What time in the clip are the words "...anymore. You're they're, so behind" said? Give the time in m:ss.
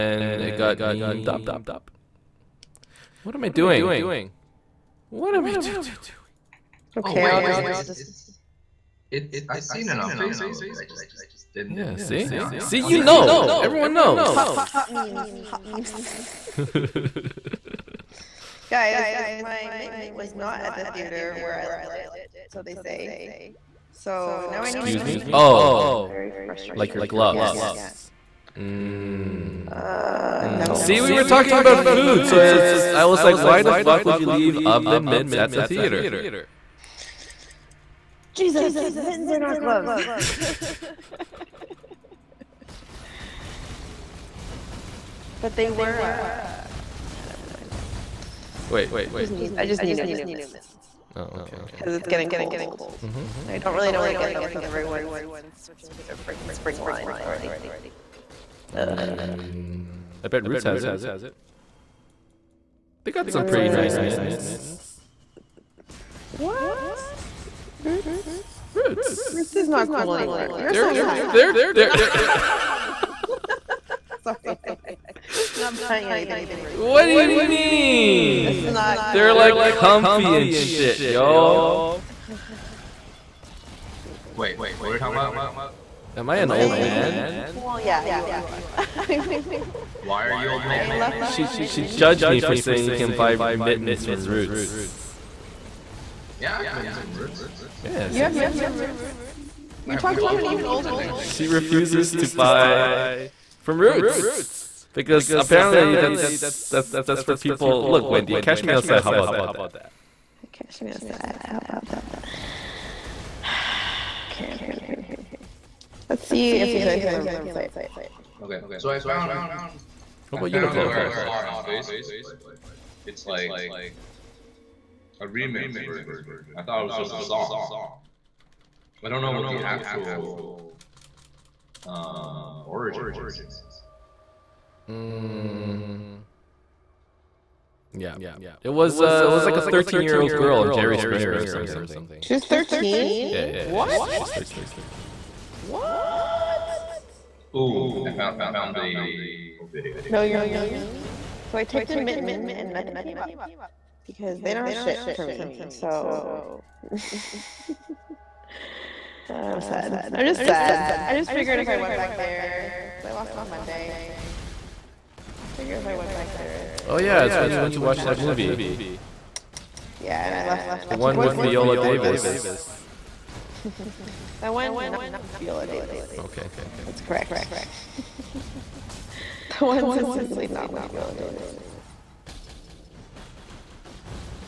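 1:10.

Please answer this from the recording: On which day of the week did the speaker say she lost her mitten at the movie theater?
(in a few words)
Monday.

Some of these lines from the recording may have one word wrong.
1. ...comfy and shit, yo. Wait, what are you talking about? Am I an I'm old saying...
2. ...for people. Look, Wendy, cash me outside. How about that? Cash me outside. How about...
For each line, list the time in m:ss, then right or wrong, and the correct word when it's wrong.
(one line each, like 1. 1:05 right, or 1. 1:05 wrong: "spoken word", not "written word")
1. 1:19 right
2. 1:47 right.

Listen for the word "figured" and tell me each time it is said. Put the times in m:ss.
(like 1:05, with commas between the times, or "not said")
2:41, 2:45.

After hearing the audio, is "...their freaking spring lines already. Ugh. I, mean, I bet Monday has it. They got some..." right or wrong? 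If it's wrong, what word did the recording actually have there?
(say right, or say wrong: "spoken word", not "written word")
wrong: "Roots", not "Monday".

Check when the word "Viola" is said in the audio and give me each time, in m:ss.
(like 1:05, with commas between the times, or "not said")
2:51, 2:55, 3:00.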